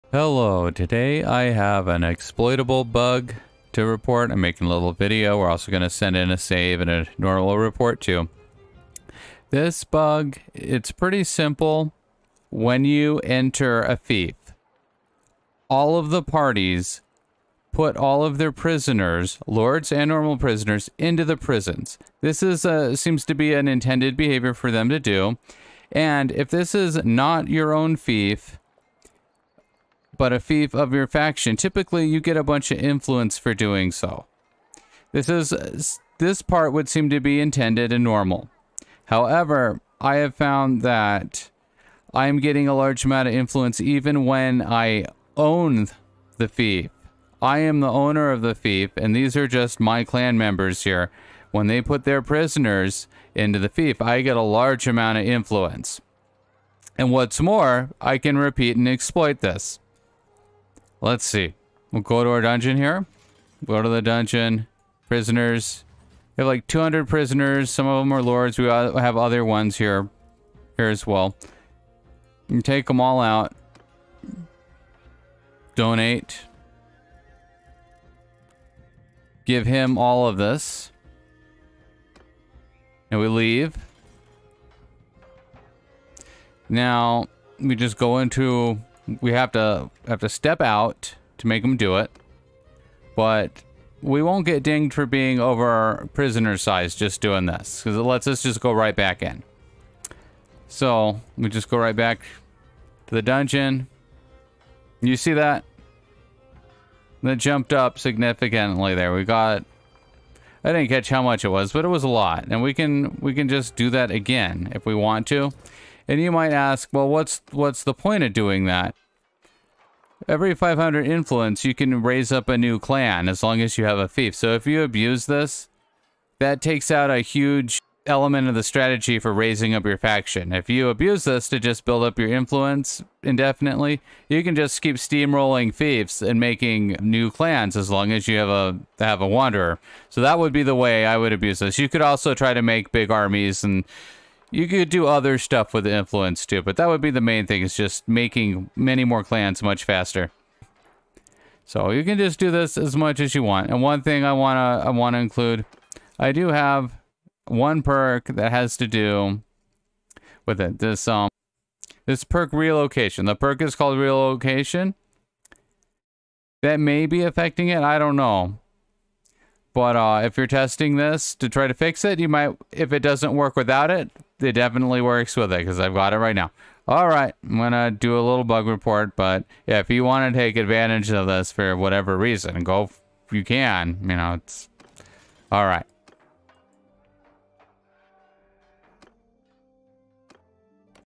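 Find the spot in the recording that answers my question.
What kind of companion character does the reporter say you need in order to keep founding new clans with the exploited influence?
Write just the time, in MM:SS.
02:19.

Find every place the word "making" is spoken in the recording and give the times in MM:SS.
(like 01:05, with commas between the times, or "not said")
00:04, 02:16, 02:28.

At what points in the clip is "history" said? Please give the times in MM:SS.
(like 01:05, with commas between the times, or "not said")
not said.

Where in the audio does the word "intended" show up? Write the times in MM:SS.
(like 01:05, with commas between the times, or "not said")
00:23, 00:37.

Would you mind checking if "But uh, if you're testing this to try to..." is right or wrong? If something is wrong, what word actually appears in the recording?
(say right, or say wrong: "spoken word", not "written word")
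right.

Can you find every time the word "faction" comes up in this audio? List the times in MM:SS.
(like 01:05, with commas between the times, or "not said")
00:31, 02:09.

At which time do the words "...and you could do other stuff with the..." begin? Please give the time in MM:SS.
02:23.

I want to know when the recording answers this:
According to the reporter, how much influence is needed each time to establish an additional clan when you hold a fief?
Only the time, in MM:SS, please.
02:00.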